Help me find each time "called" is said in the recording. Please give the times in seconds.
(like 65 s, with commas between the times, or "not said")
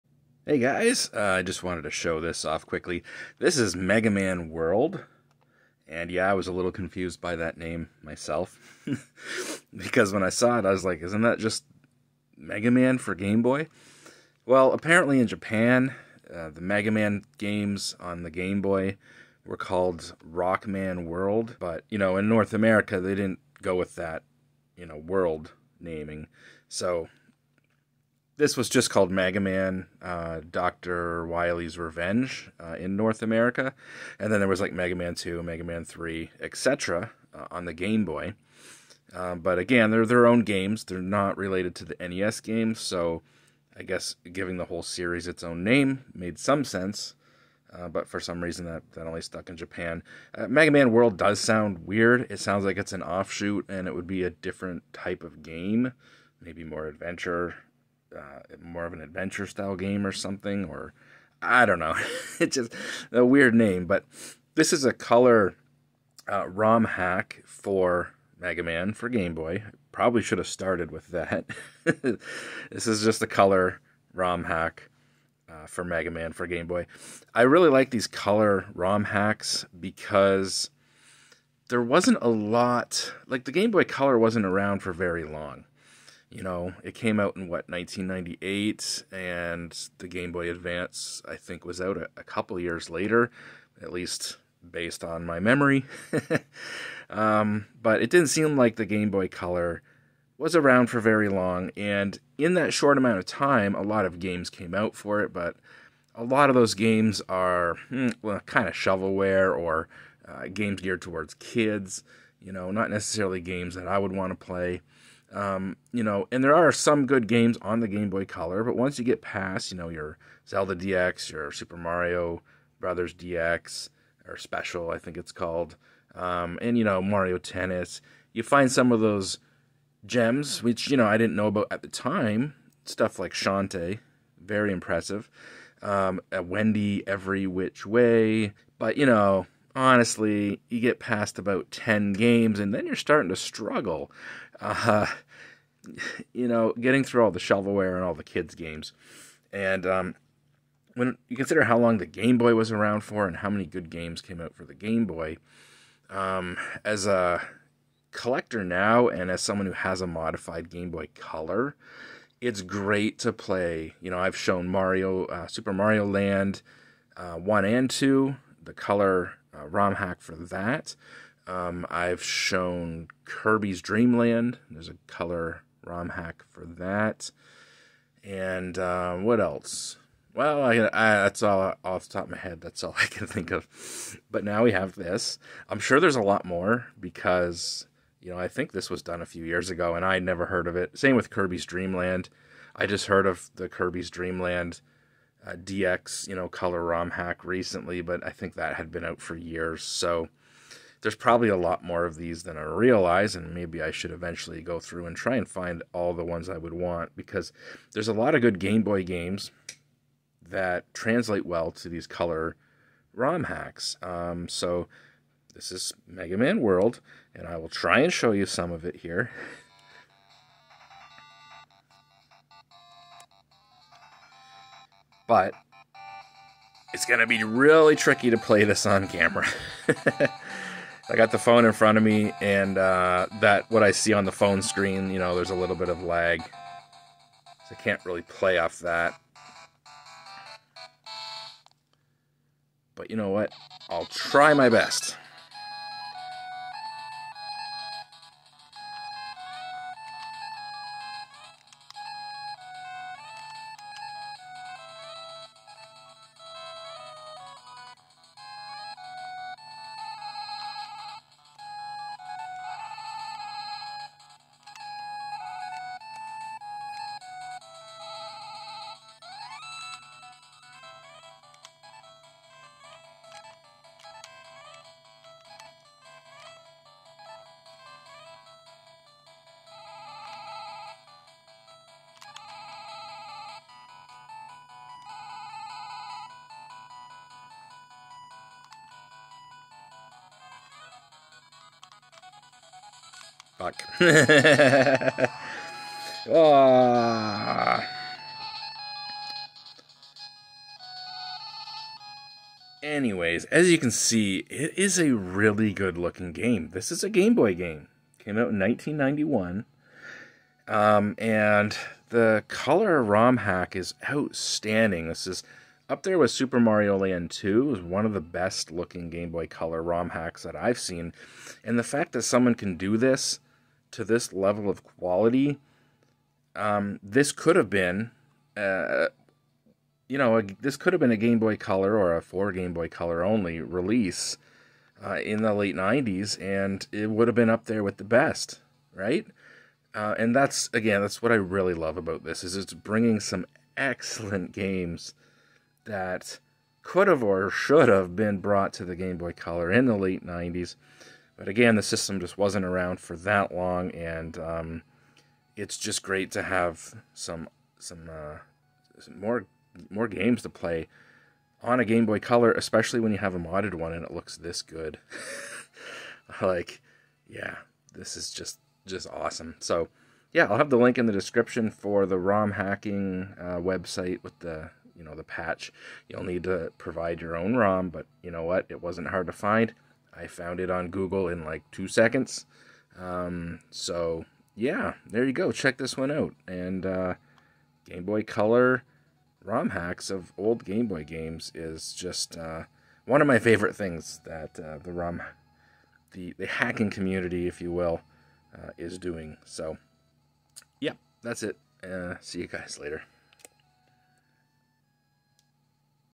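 19 s, 28 s, 125 s.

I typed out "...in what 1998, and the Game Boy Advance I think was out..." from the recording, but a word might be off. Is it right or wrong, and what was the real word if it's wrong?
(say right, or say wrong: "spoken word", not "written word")
right.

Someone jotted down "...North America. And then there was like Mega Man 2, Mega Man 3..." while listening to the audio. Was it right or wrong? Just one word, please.
right.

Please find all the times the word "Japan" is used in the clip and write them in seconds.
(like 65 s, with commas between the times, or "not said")
15 s, 49 s.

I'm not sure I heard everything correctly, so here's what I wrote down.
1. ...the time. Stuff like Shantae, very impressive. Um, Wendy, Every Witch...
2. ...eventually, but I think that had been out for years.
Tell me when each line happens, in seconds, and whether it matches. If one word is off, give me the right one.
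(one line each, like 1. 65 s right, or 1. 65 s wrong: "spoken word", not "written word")
1. 131 s right
2. 197 s wrong: "recently", not "eventually".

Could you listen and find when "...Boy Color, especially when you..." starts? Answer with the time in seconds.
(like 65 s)
362 s.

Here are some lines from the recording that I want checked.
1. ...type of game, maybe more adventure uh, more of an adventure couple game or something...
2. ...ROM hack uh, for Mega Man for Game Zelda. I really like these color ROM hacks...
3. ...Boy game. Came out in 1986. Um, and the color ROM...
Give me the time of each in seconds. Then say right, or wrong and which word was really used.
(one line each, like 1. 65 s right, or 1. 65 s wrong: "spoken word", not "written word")
1. 54 s wrong: "style", not "couple"
2. 74 s wrong: "Boy", not "Zelda"
3. 307 s wrong: "1991", not "1986".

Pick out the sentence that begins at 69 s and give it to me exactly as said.
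Probably should have started with that.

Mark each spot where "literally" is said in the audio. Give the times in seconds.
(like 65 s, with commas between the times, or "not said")
not said.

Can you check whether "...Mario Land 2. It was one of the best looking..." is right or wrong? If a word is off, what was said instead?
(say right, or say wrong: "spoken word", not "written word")
right.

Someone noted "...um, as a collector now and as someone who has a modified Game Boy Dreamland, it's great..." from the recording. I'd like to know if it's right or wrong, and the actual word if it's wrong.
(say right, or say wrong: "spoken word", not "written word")
wrong: "Color", not "Dreamland".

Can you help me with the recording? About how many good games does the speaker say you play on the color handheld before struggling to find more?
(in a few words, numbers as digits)
10.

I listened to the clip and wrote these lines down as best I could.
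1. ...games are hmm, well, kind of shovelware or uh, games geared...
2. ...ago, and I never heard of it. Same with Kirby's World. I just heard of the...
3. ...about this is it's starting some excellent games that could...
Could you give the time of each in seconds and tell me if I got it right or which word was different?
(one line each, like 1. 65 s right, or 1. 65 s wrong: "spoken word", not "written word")
1. 106 s right
2. 189 s wrong: "Dreamland", not "World"
3. 341 s wrong: "bringing", not "starting".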